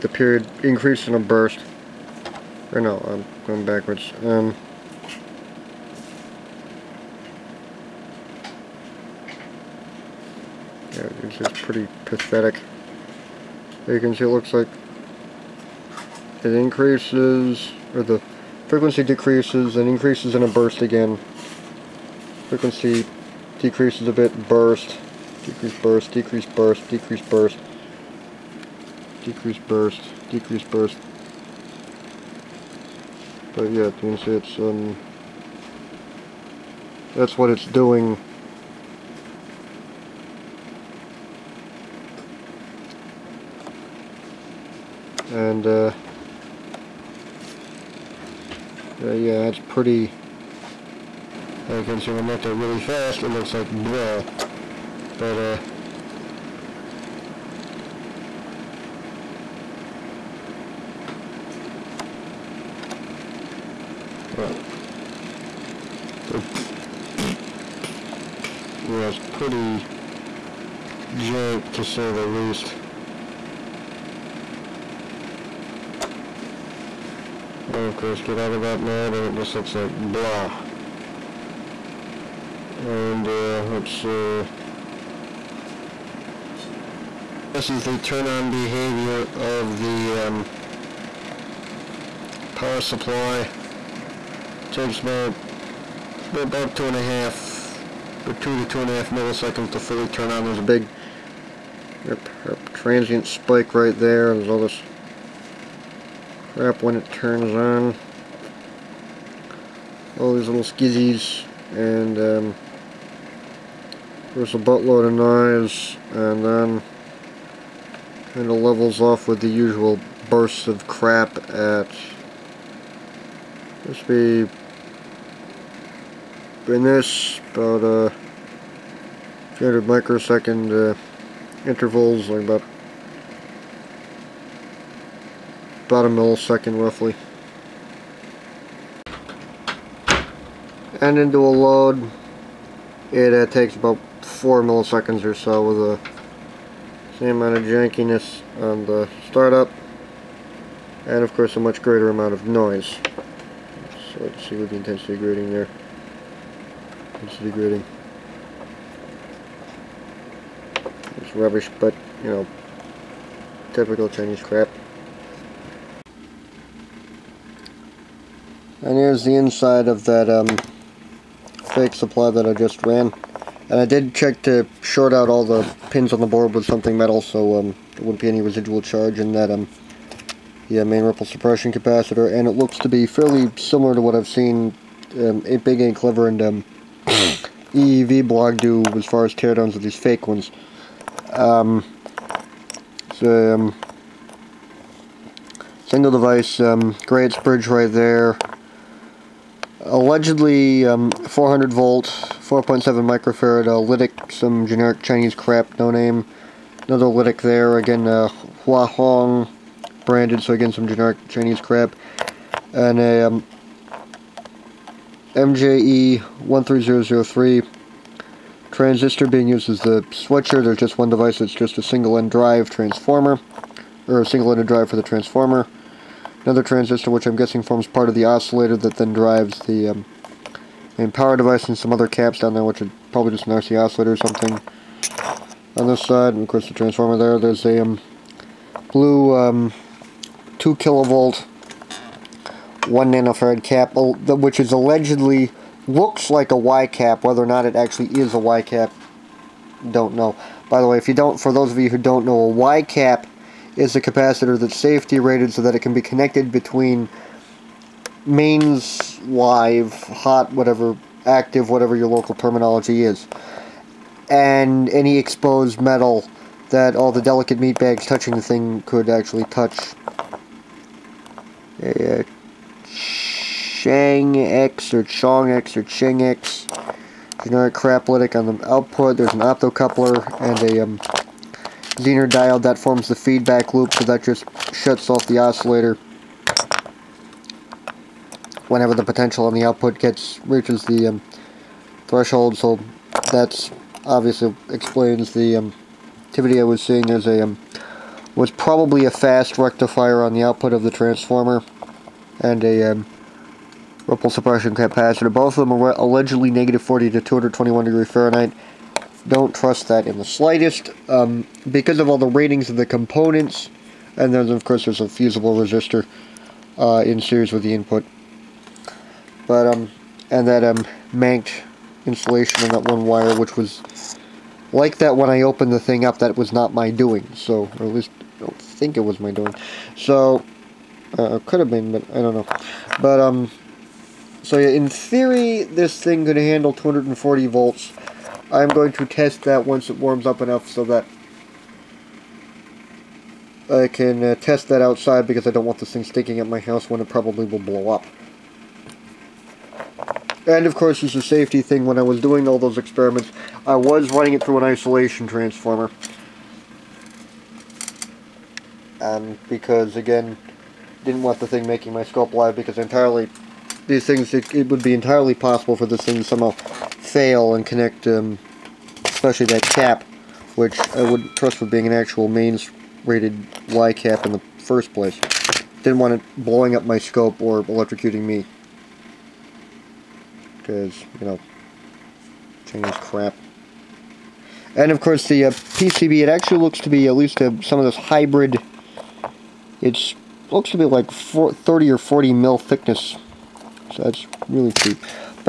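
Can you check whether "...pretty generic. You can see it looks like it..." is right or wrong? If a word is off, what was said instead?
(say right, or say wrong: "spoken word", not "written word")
wrong: "pathetic", not "generic".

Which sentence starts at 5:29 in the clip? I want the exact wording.
So, uh, could have been, but I don't know.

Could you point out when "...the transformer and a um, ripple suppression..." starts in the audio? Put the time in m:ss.
5:00.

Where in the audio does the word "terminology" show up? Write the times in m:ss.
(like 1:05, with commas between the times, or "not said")
4:22.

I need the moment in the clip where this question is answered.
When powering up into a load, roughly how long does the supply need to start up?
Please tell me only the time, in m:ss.
2:24.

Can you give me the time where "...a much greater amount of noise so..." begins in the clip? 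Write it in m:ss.
2:31.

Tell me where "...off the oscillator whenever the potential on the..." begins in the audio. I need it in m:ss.
4:45.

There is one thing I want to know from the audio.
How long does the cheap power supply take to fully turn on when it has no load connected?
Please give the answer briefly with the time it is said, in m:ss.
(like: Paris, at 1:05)
2 to 2.5 milliseconds, at 1:38.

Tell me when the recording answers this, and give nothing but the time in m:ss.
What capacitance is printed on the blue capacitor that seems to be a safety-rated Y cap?
4:02.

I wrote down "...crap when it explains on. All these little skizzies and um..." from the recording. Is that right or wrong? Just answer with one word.
wrong.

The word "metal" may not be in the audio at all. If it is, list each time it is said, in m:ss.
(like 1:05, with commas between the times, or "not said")
2:56, 4:25.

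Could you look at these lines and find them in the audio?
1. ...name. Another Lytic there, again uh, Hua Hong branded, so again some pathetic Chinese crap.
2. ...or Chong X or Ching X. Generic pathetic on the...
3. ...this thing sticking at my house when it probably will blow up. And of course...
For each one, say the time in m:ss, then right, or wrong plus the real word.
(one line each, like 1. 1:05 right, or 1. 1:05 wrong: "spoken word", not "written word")
1. 3:25 wrong: "generic", not "pathetic"
2. 4:34 wrong: "craplitic", not "pathetic"
3. 5:45 right.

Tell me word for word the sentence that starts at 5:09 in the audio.
Don't trust that in the slightest.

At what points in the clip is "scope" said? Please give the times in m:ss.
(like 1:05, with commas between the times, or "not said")
6:02, 6:16.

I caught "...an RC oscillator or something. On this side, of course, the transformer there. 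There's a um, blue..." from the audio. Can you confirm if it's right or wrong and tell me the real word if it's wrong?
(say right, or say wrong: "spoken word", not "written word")
right.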